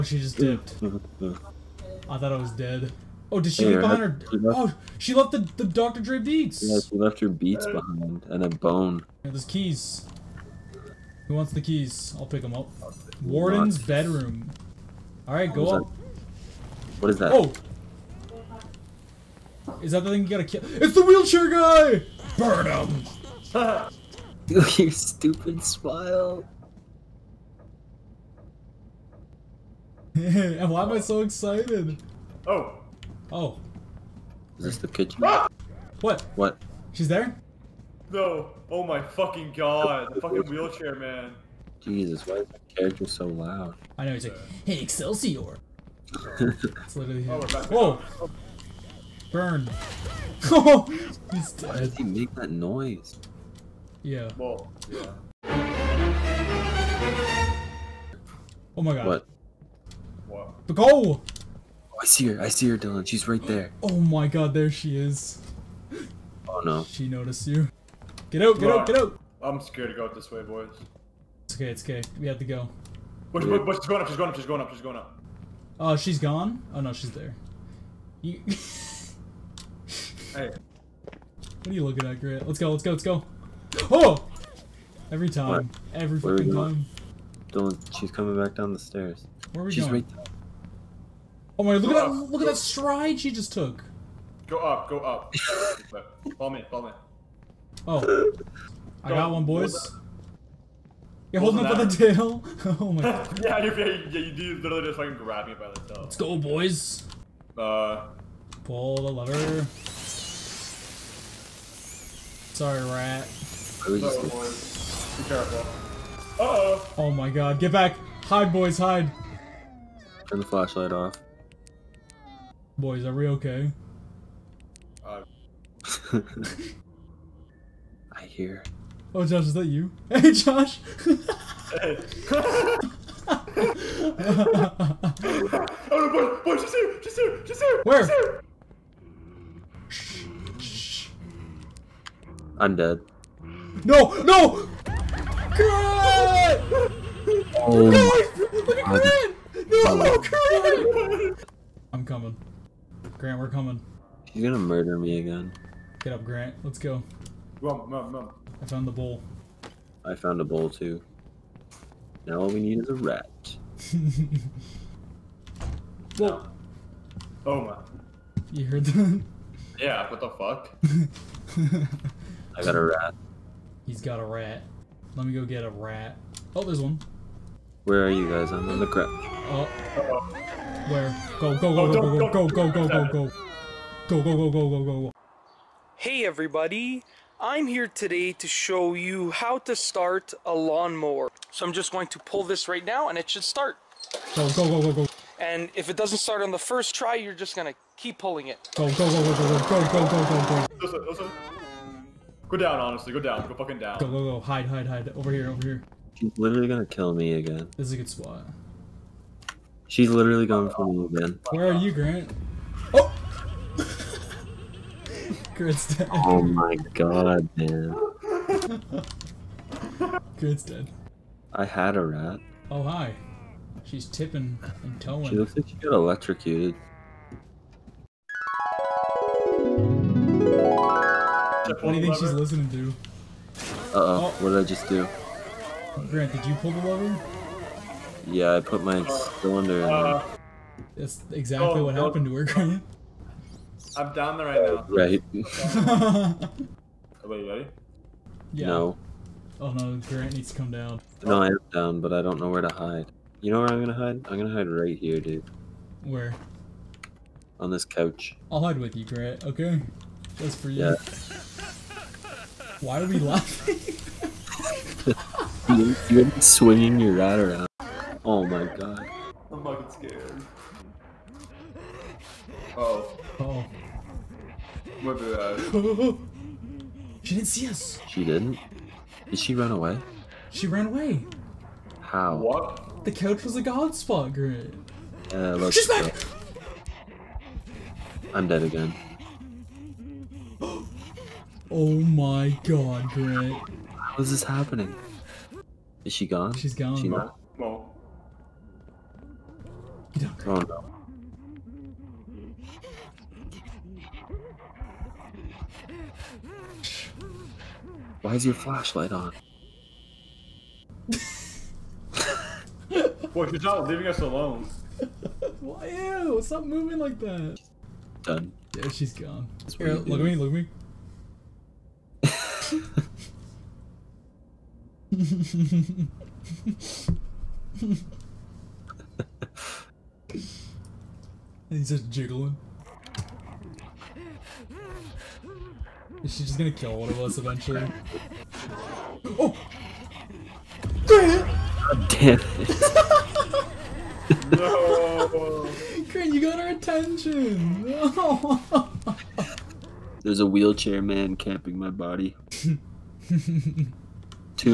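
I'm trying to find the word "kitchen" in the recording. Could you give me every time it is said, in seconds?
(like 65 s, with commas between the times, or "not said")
34 s.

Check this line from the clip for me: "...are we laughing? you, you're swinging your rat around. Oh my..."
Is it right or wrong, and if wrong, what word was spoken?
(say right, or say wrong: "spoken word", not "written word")
right.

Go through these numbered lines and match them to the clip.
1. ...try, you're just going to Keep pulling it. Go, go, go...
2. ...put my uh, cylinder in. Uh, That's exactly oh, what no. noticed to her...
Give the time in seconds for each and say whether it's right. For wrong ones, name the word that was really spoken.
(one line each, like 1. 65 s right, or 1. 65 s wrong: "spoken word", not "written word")
1. 196 s right
2. 238 s wrong: "happened", not "noticed".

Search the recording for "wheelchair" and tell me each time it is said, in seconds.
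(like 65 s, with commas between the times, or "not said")
21 s, 40 s, 350 s.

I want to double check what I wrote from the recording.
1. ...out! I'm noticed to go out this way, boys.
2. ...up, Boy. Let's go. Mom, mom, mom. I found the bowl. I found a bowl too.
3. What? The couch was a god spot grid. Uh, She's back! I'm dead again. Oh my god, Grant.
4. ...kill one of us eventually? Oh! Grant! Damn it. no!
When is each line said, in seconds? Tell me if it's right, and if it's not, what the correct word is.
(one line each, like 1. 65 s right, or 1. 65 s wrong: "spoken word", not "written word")
1. 68 s wrong: "scared", not "noticed"
2. 156 s wrong: "Grant", not "Boy"
3. 282 s right
4. 336 s right.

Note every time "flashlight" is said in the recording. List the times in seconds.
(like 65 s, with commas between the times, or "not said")
120 s, 308 s.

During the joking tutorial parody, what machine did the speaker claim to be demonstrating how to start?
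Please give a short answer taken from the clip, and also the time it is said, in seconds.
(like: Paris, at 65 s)
lawnmower, at 189 s.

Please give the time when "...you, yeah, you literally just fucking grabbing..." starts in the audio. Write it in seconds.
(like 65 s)
103 s.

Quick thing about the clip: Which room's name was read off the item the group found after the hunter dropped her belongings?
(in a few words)
Warden's bedroom.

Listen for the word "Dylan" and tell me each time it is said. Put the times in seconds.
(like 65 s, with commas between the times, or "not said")
62 s, 87 s.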